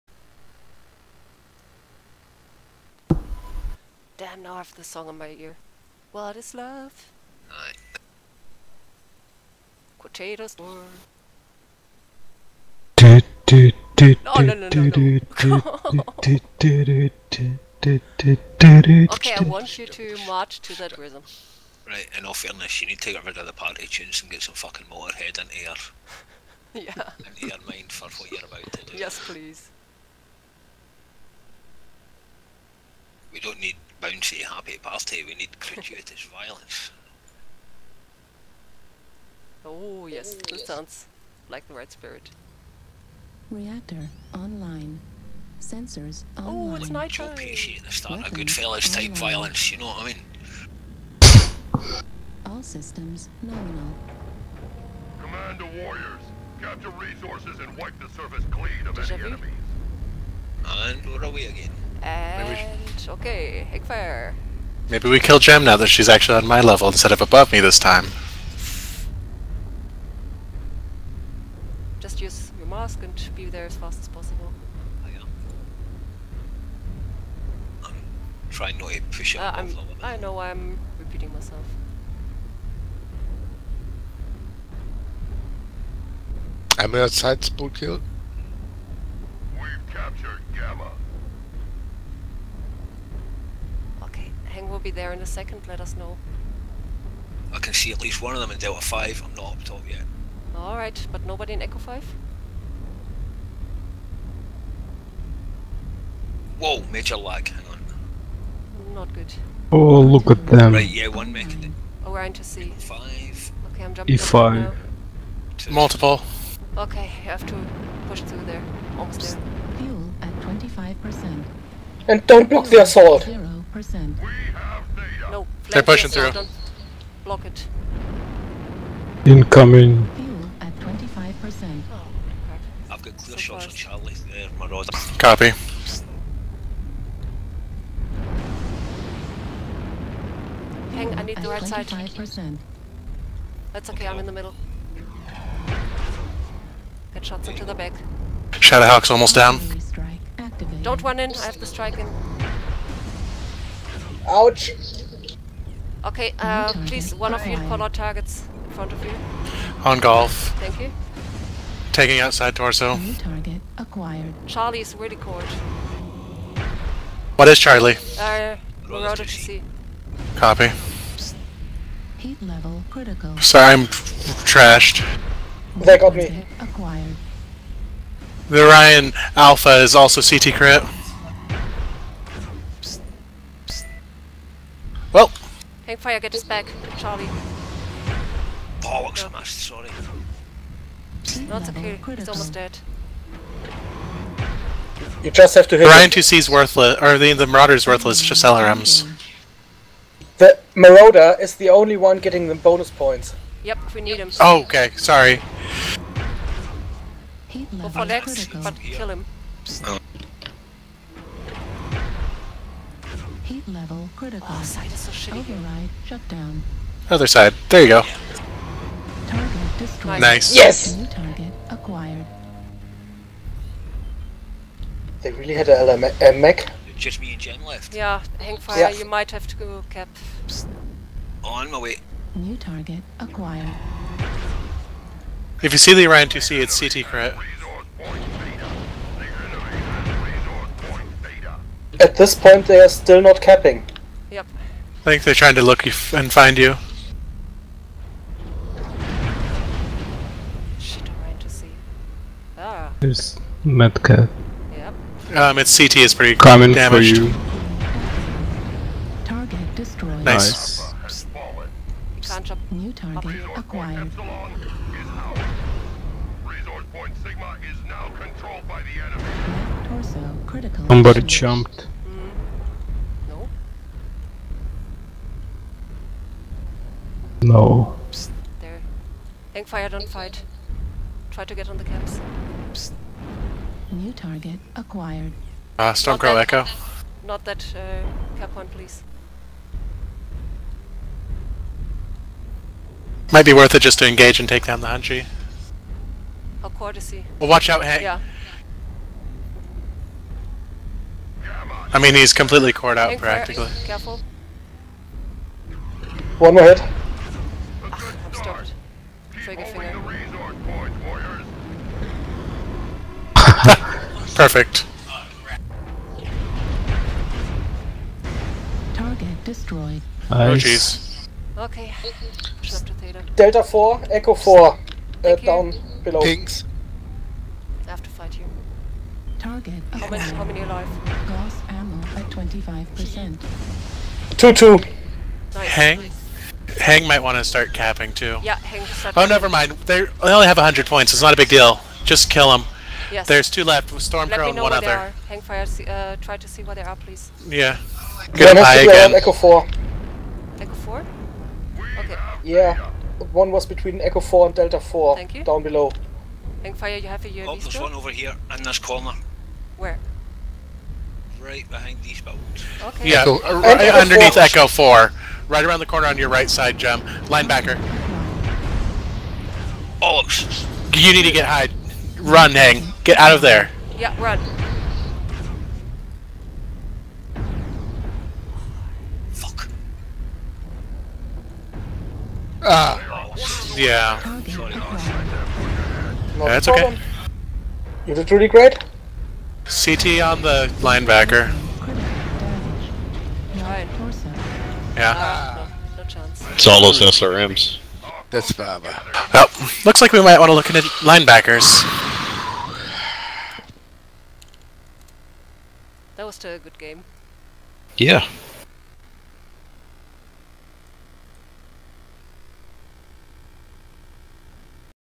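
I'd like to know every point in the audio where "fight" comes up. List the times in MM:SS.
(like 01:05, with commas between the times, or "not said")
04:40, 05:28.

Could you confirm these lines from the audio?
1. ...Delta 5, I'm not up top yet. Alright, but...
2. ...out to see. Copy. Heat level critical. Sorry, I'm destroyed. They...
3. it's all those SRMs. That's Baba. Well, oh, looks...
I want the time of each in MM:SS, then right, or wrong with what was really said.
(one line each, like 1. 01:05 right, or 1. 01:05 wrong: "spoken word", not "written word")
1. 01:38 right
2. 02:48 wrong: "trashed", not "destroyed"
3. 06:36 right.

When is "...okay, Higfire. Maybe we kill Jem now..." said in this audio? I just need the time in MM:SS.
01:03.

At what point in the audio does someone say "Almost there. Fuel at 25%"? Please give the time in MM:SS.
01:58.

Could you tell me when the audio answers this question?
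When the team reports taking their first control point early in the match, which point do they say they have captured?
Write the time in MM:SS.
01:29.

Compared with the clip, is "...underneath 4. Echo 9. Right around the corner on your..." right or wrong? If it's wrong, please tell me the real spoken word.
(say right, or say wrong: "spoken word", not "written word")
wrong: "4", not "9".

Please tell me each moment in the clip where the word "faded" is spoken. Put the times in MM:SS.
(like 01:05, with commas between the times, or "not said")
not said.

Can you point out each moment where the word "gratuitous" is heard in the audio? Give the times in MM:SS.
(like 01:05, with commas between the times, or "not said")
00:35.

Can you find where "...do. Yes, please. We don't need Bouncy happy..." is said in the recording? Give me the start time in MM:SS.
00:28.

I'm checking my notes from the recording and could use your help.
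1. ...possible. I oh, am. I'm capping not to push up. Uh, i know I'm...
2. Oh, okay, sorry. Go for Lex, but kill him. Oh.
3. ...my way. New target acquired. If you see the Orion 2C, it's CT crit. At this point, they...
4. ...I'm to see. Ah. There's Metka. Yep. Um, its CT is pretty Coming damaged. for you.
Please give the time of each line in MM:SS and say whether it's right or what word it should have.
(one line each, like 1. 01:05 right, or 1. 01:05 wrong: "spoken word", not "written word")
1. 01:14 wrong: "trying", not "capping"
2. 03:24 right
3. 03:51 right
4. 04:11 right.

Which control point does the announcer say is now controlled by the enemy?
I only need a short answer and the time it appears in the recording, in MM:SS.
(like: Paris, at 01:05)
Sigma, at 04:26.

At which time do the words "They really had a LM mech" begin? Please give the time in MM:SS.
03:45.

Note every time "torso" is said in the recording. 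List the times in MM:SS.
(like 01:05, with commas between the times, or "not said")
02:42, 04:29.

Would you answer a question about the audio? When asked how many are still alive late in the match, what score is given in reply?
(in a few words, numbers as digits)
2-2.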